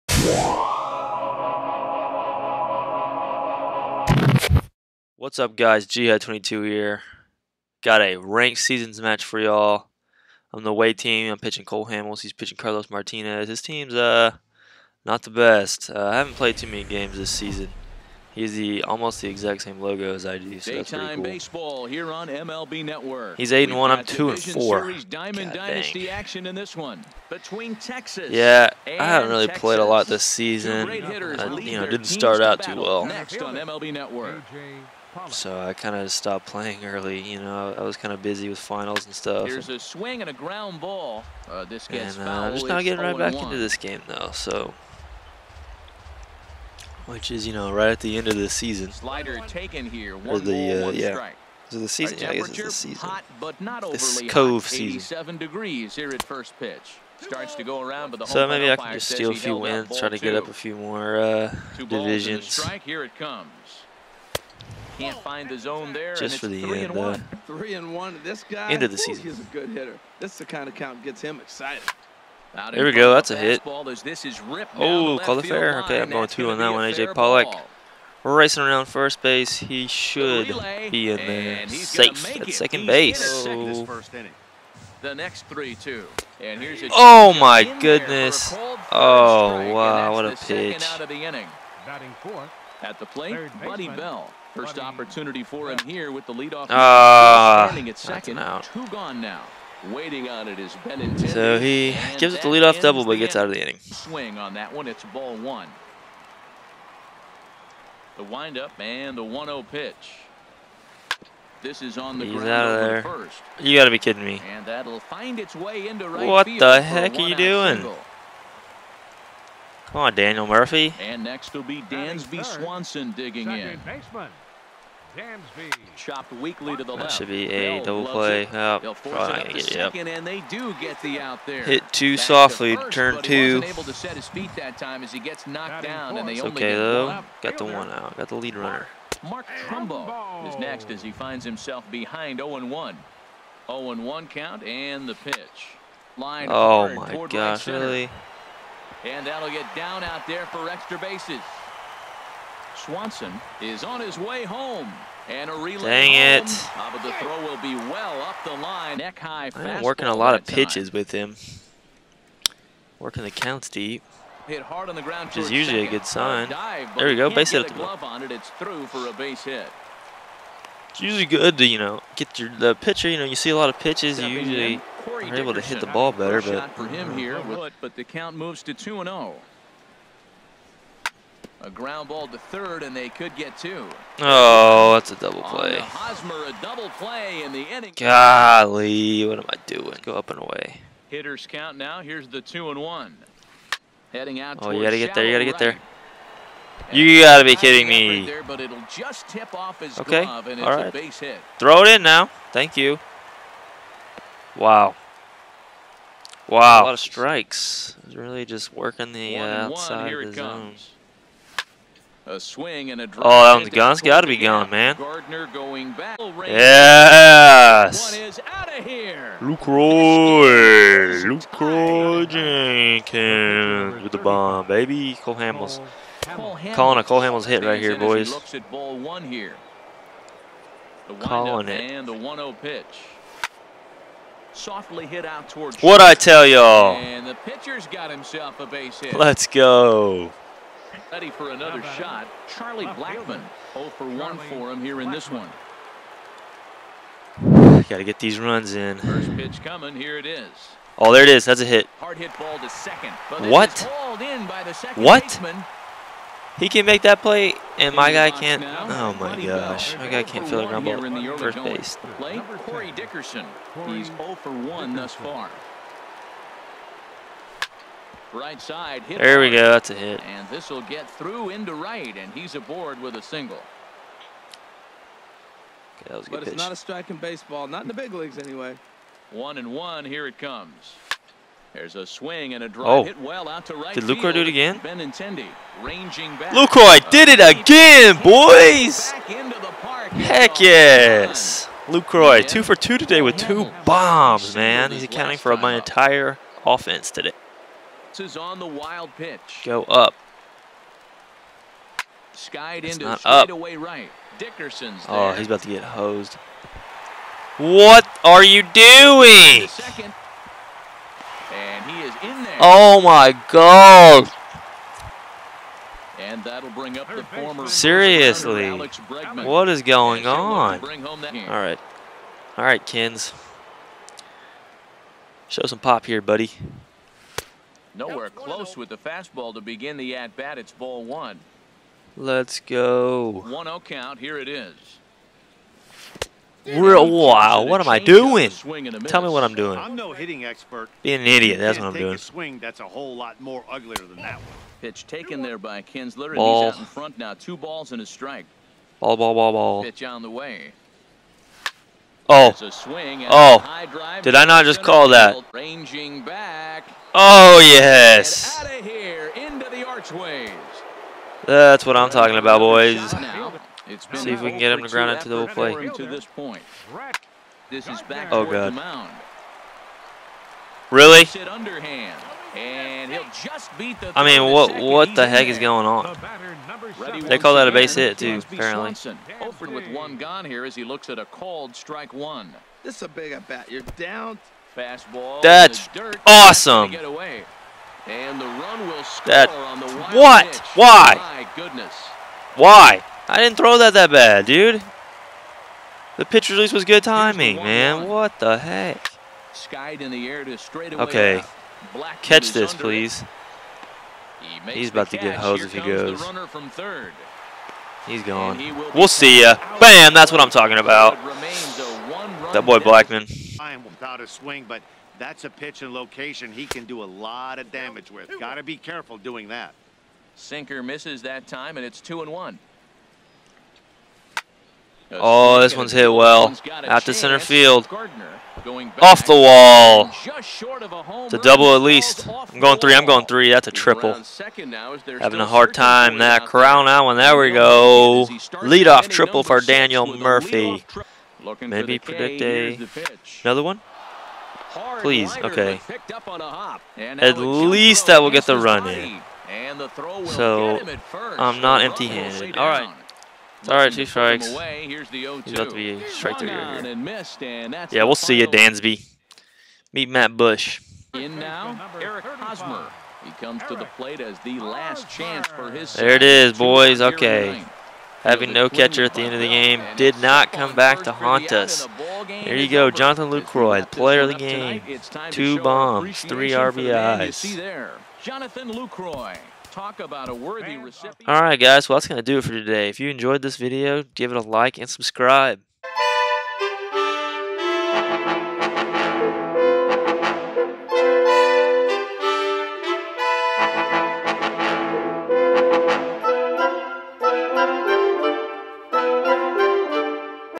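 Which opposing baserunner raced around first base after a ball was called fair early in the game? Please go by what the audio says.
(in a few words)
AJ Pollock.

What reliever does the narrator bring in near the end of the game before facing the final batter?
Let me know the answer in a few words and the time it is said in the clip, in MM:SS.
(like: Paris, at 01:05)
Matt Bush, at 07:40.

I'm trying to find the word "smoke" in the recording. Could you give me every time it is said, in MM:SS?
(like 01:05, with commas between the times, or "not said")
not said.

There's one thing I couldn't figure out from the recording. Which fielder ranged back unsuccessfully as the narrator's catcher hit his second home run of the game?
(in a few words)
Benintendi.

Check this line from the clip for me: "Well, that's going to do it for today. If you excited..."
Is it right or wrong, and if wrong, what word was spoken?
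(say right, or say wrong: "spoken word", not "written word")
wrong: "enjoyed", not "excited".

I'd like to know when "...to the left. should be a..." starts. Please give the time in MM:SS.
02:06.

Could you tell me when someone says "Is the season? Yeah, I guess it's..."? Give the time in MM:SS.
00:51.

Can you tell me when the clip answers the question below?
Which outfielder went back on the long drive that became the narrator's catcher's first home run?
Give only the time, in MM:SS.
03:34.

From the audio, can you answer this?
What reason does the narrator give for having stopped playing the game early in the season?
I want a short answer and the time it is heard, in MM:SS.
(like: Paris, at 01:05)
finals, at 00:38.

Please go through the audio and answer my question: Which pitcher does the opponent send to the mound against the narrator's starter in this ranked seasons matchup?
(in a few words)
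Carlos Martinez.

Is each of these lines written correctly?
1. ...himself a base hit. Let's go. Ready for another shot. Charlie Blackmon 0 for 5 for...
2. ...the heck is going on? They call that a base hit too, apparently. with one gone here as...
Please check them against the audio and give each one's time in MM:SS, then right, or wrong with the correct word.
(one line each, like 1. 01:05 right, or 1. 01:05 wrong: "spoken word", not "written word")
1. 03:58 wrong: "1", not "5"
2. 06:15 right.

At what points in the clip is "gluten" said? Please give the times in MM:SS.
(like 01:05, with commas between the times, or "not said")
not said.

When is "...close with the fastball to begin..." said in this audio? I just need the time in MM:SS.
05:28.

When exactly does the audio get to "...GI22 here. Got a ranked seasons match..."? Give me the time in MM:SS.
00:05.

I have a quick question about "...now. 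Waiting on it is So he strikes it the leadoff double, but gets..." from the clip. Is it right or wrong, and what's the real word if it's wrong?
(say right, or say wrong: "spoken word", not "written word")
wrong: "gives", not "strikes".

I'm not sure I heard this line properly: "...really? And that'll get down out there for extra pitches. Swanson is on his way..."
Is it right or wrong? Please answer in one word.
wrong.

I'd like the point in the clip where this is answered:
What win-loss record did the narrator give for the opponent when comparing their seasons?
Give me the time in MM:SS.
00:23.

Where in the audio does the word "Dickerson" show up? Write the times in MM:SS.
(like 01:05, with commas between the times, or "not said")
04:22, 05:04.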